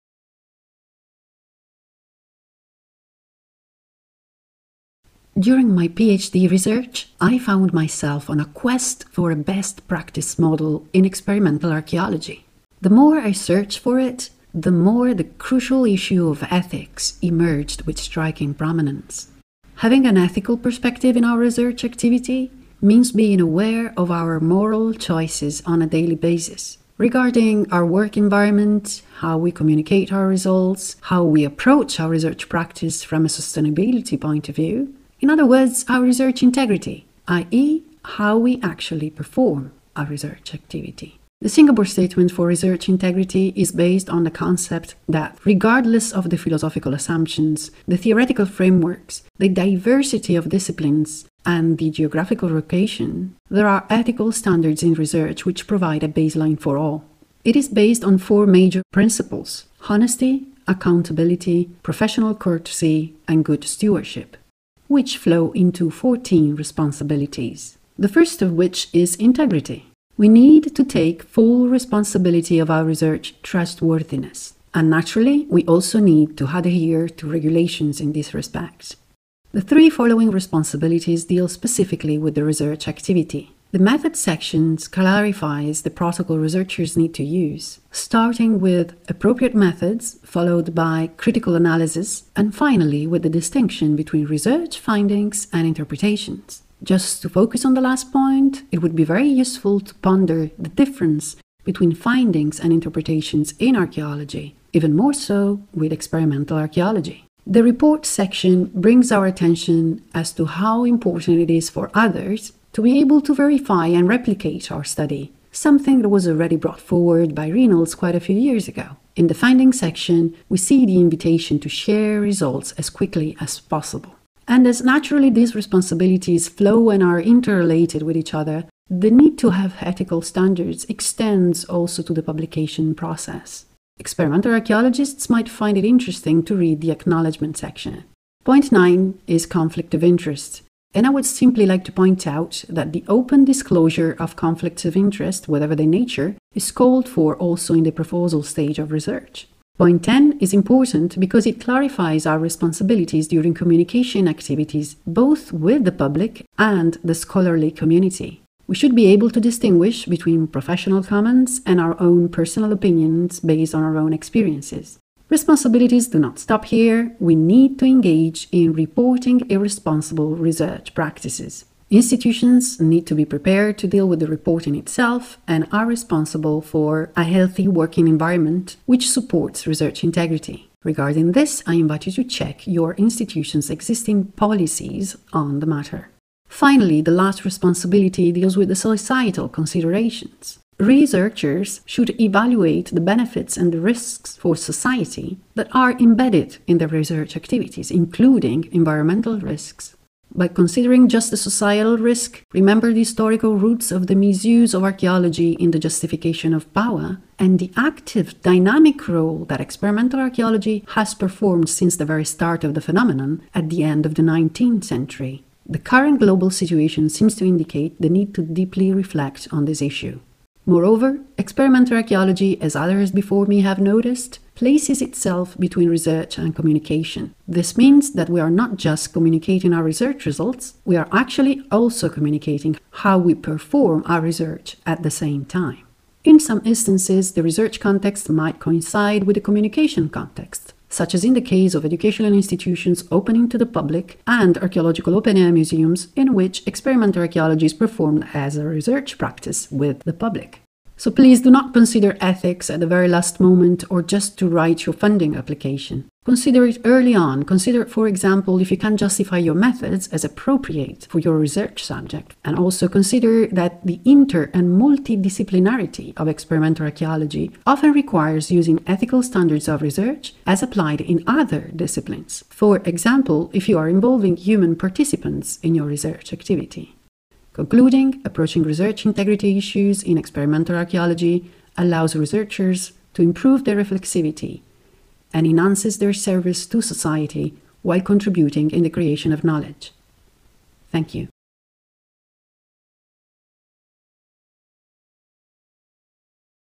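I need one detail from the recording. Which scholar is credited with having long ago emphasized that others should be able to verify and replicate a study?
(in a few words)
Reynolds.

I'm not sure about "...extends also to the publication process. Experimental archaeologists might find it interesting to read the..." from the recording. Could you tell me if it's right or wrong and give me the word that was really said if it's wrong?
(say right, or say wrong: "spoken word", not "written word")
right.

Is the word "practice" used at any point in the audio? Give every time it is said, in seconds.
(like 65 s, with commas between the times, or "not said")
9 s, 32 s, 170 s, 249 s.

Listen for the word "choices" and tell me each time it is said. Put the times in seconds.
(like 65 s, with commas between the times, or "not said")
24 s.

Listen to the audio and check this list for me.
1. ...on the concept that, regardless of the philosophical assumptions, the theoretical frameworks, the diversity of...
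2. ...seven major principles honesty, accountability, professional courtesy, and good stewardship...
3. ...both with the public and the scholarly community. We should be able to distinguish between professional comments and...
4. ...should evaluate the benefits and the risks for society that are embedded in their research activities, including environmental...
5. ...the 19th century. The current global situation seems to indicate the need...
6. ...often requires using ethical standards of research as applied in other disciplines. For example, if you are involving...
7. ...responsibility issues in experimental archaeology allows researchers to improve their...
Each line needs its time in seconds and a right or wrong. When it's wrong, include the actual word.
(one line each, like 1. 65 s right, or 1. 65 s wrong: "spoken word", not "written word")
1. 44 s right
2. 58 s wrong: "four", not "seven"
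3. 155 s right
4. 191 s right
5. 214 s right
6. 267 s right
7. 279 s wrong: "integrity", not "responsibility".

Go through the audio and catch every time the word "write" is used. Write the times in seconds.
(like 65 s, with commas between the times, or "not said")
254 s.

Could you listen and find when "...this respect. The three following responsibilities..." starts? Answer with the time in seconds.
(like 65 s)
78 s.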